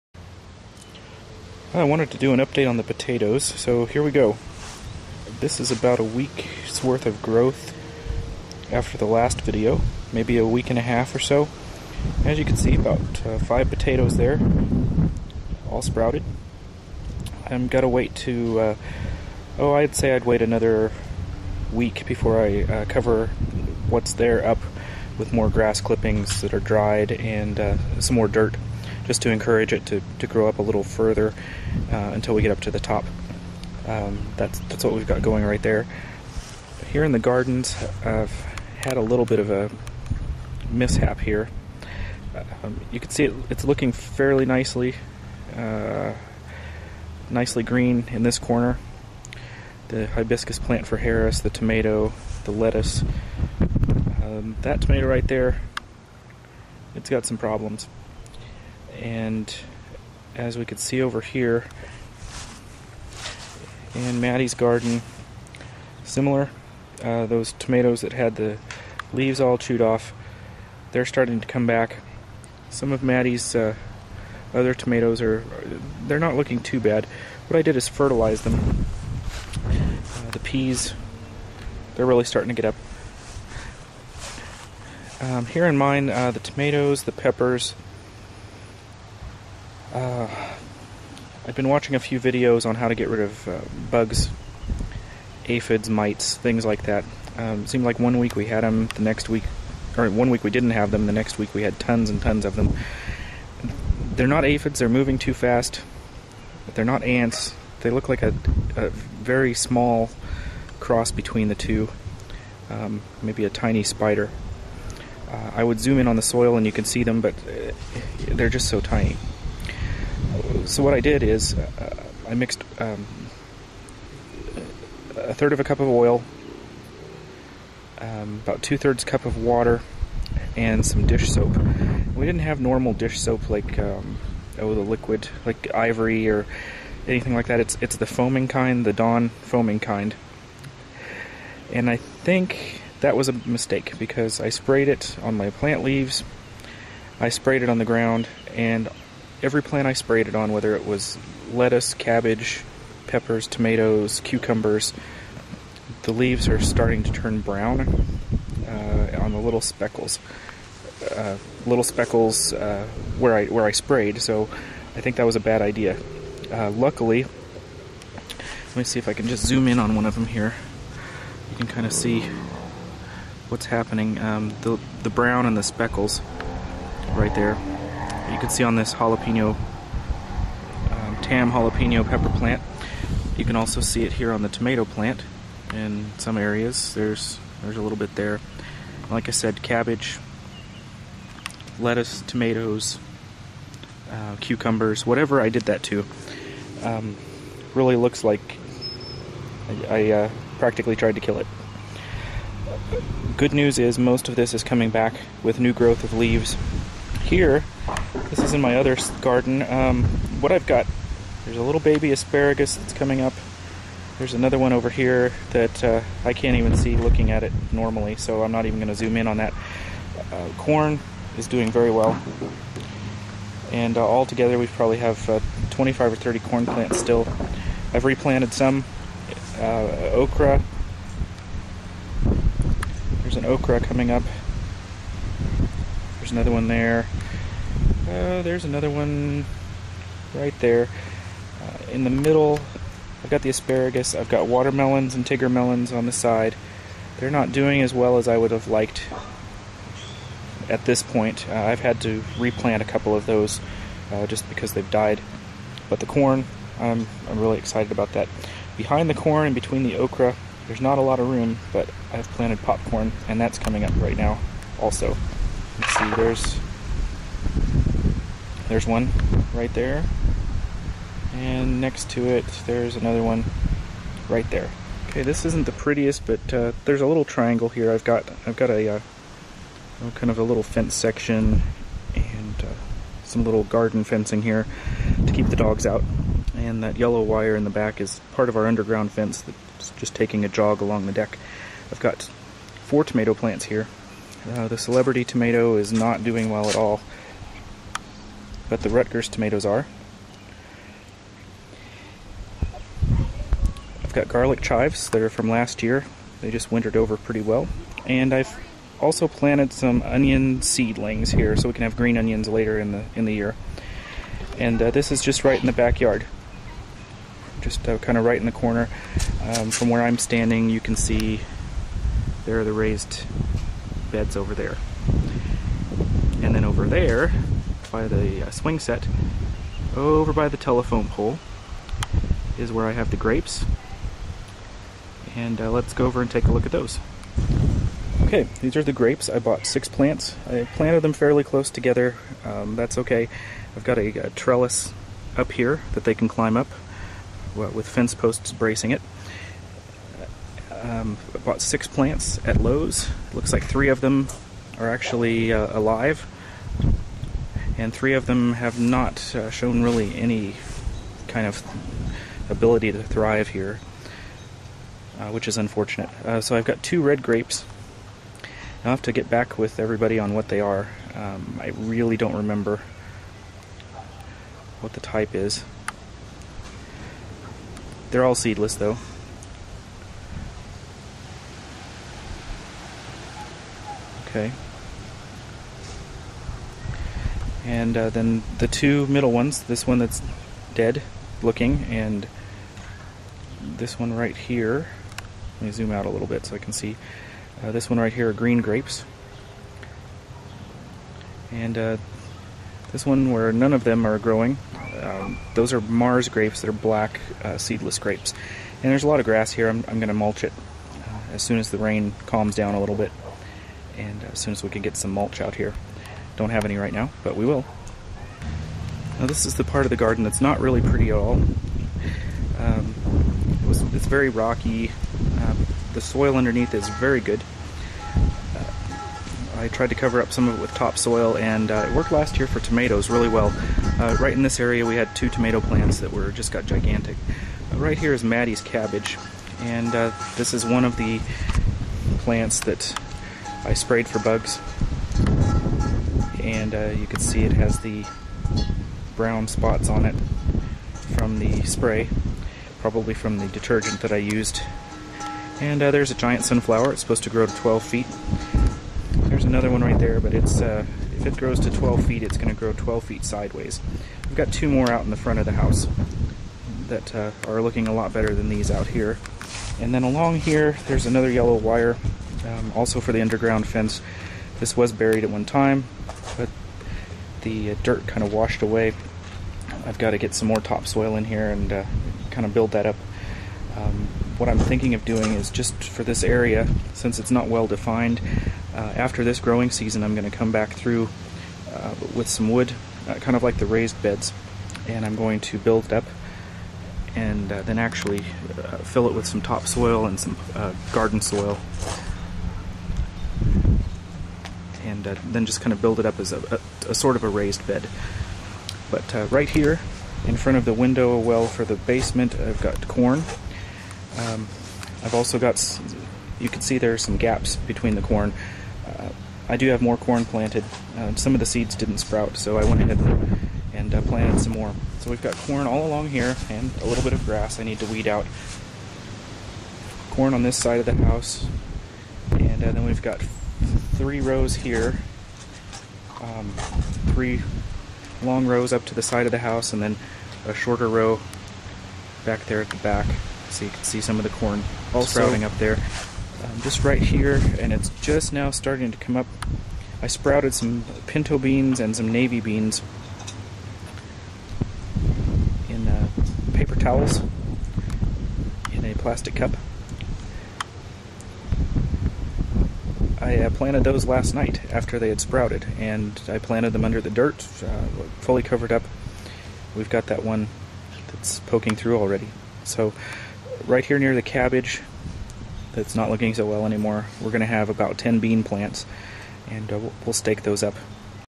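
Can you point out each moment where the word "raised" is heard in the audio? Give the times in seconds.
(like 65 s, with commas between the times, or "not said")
322 s, 493 s, 507 s.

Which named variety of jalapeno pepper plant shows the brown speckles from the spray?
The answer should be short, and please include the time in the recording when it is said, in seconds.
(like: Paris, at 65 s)
Tam, at 181 s.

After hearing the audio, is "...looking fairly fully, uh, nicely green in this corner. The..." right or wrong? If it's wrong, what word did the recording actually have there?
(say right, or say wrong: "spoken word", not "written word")
wrong: "nicely", not "fully".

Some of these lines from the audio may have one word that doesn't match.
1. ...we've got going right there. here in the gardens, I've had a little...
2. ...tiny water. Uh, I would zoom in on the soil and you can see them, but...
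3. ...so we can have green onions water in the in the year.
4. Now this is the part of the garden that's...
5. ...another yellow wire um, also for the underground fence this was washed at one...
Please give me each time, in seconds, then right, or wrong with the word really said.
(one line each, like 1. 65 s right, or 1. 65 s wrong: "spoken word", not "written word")
1. 34 s right
2. 113 s wrong: "spider", not "water"
3. 311 s wrong: "later", not "water"
4. 419 s right
5. 471 s wrong: "buried", not "washed".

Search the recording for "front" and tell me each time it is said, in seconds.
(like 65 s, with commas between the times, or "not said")
465 s, 510 s.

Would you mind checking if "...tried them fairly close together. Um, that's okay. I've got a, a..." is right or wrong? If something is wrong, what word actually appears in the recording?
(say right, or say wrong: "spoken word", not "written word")
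wrong: "planted", not "tried".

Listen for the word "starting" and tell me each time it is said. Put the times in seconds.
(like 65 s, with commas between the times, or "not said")
71 s, 82 s, 156 s, 548 s.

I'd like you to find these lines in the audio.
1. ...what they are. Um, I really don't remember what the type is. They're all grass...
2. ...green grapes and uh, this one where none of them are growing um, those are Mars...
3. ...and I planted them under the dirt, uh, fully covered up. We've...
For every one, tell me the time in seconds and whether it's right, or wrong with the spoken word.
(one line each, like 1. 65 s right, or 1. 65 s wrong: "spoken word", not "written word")
1. 370 s wrong: "seedless", not "grass"
2. 398 s right
3. 565 s right.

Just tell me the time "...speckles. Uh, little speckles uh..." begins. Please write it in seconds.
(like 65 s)
159 s.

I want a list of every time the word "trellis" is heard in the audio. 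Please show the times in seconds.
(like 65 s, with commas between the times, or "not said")
344 s.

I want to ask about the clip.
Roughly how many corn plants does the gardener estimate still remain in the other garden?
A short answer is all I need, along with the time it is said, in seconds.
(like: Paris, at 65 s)
25 or 30, at 225 s.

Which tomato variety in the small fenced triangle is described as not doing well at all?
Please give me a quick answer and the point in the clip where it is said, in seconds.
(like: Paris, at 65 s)
Celebrity, at 294 s.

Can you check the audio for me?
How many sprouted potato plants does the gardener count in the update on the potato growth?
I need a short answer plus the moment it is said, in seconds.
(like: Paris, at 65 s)
5, at 13 s.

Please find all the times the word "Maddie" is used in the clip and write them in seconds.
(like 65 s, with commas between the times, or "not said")
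64 s, 73 s, 438 s.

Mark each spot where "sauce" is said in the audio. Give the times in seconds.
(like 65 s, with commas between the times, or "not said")
not said.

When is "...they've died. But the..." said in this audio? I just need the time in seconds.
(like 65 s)
254 s.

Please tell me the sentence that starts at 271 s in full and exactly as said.
And next to it, there's another one right there.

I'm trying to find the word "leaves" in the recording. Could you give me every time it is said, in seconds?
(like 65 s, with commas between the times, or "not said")
69 s, 145 s, 156 s, 206 s.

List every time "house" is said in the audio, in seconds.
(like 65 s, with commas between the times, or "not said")
465 s, 531 s, 539 s.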